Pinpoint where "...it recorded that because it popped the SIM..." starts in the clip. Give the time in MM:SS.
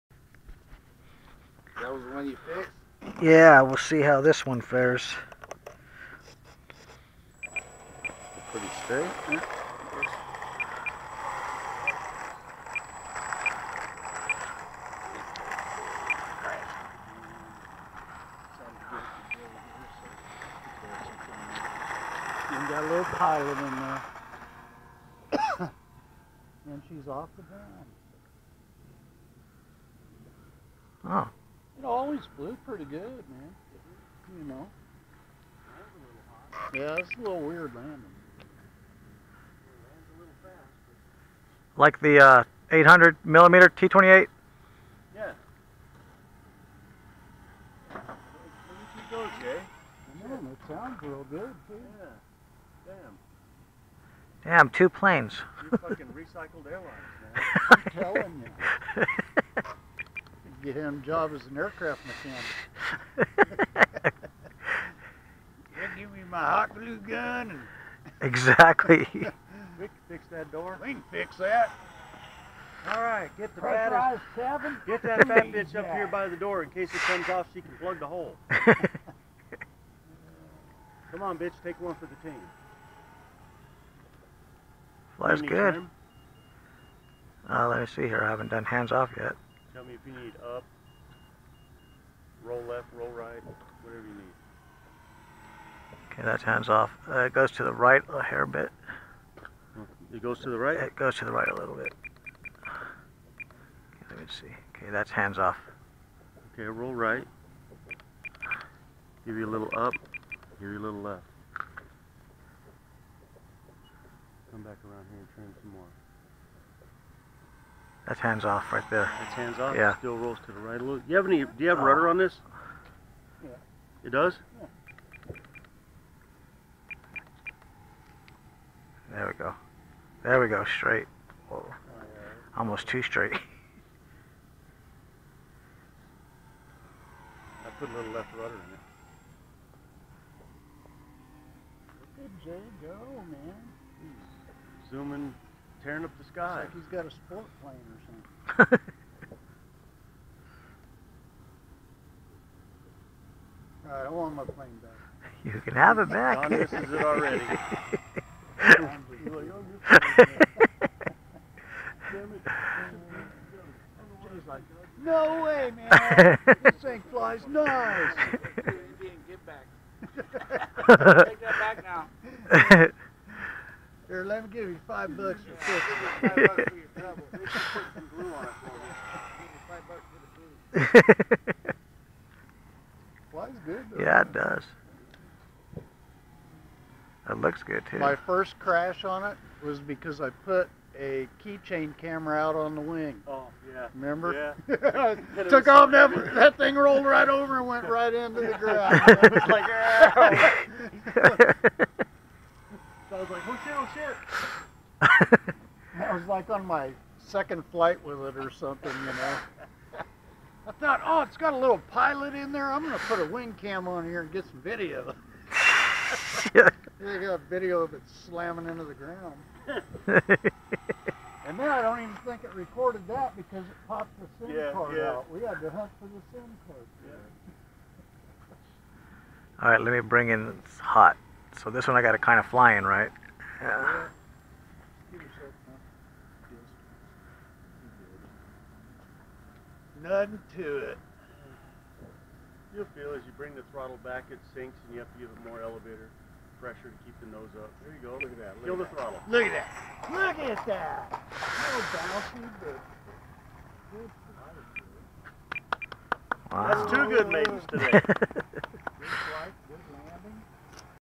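03:42.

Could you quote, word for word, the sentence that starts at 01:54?
Come back around here and trim some more.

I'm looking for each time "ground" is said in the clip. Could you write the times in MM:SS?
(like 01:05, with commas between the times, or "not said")
00:27, 03:18, 03:38.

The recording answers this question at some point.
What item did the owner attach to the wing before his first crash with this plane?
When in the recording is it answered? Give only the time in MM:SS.
03:11.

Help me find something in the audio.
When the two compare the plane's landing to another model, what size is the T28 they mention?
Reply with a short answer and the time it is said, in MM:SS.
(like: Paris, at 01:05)
800 millimeter, at 00:42.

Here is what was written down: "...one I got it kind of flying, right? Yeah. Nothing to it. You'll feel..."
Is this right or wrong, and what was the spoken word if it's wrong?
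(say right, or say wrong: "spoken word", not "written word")
right.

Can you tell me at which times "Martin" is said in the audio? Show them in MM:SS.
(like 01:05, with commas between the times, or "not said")
not said.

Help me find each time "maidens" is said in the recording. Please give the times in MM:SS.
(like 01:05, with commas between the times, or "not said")
04:17.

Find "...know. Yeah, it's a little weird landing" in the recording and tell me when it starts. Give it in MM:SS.
00:34.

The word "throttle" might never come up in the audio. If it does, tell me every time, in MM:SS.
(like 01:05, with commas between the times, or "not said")
04:03, 04:08.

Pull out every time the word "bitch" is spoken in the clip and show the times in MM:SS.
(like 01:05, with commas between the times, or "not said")
01:15, 01:21.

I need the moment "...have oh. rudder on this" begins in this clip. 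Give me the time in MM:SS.
02:01.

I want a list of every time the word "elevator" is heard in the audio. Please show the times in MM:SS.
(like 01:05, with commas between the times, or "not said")
04:05.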